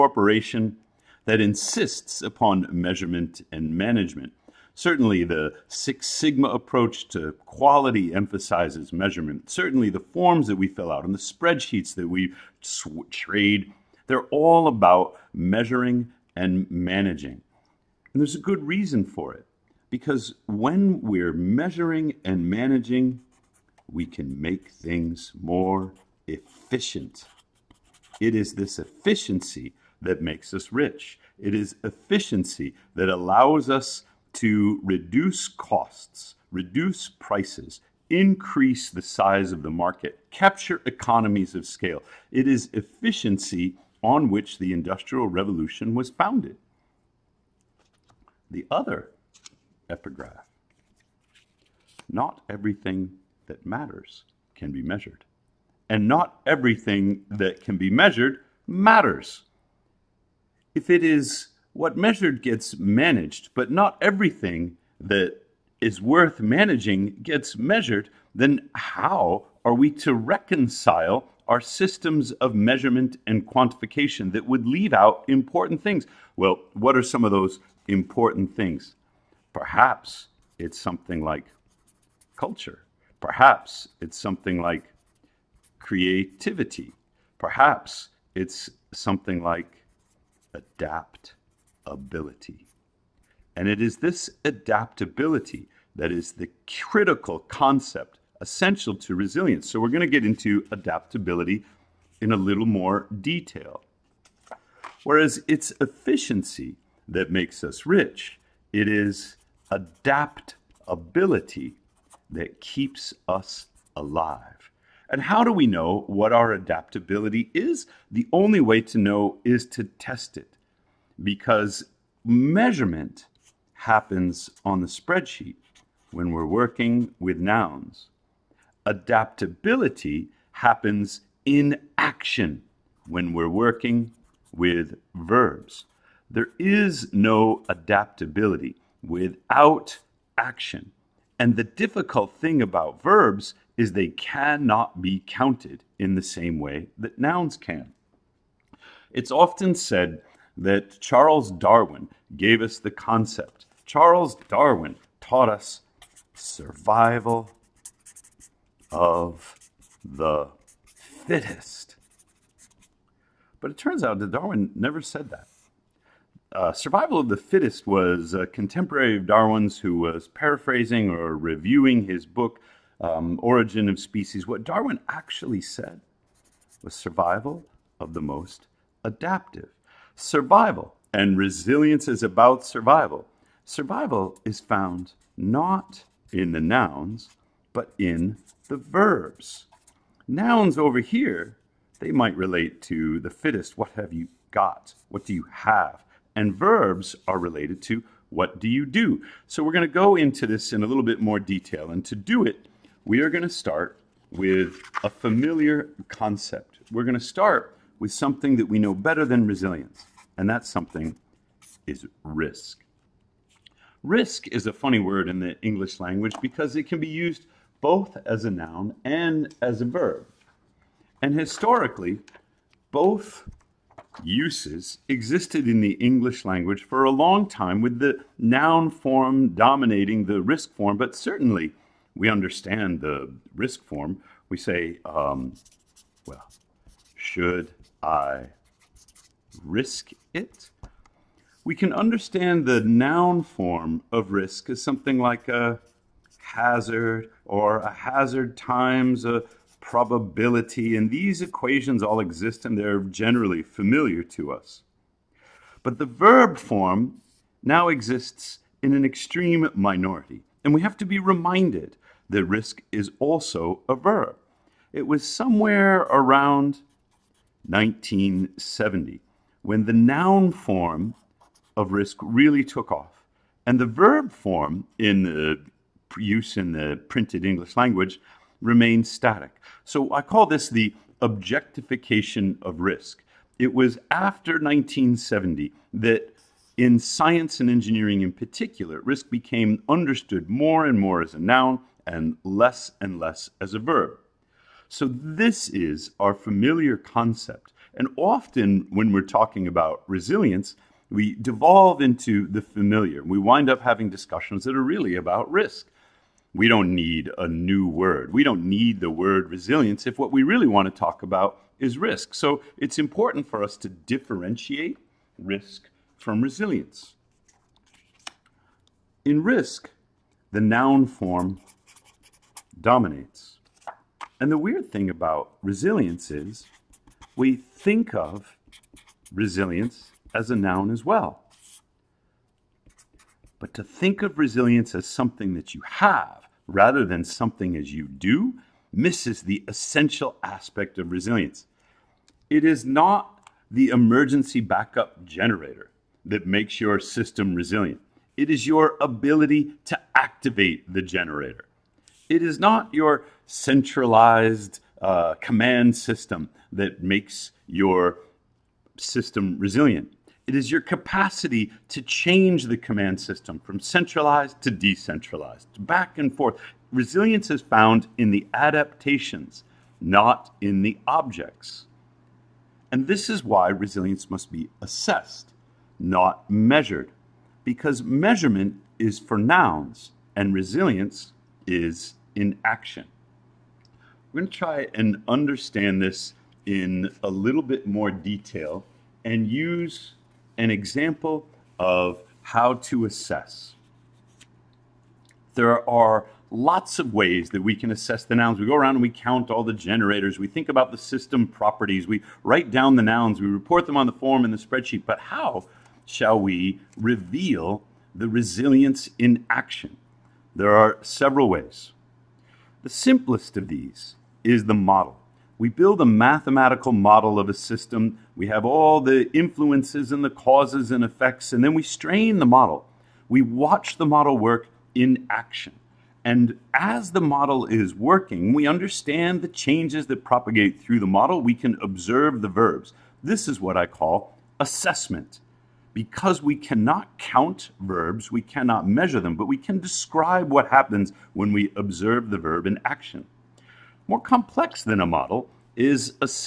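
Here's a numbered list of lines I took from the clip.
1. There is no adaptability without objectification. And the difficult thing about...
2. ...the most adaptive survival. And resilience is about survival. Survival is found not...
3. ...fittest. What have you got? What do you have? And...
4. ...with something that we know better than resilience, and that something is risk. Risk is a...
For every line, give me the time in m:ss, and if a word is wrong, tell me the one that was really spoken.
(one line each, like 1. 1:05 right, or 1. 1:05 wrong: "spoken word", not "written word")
1. 2:16 wrong: "action", not "objectification"
2. 2:58 right
3. 3:13 right
4. 3:28 right.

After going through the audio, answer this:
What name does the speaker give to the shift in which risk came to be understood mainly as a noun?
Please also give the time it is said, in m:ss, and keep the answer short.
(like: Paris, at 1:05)
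objectification of risk, at 4:41.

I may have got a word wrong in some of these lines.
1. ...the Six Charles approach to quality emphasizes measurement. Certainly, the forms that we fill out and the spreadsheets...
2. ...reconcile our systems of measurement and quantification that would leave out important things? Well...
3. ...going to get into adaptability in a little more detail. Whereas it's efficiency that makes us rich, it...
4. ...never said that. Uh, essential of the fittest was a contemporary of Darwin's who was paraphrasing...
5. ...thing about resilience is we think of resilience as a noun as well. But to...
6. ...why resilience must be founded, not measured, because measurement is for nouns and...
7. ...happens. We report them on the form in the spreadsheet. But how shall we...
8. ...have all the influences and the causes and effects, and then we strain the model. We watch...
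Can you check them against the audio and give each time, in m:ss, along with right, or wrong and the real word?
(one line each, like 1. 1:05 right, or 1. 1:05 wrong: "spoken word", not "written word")
1. 0:05 wrong: "Sigma", not "Charles"
2. 1:10 right
3. 1:39 right
4. 2:44 wrong: "survival", not "essential"
5. 5:24 right
6. 6:13 wrong: "assessed", not "founded"
7. 6:43 wrong: "nouns", not "happens"
8. 6:58 right.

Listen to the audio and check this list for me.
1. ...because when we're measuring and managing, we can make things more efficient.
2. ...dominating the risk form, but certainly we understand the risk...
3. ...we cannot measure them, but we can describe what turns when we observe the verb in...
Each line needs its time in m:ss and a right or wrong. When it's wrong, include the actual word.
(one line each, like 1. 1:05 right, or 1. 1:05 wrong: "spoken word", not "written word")
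1. 0:19 right
2. 3:49 right
3. 7:18 wrong: "happens", not "turns".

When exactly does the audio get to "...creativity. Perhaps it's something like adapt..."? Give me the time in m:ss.
1:25.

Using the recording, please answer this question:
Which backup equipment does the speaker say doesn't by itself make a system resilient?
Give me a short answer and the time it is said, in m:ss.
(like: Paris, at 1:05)
emergency backup generator, at 5:43.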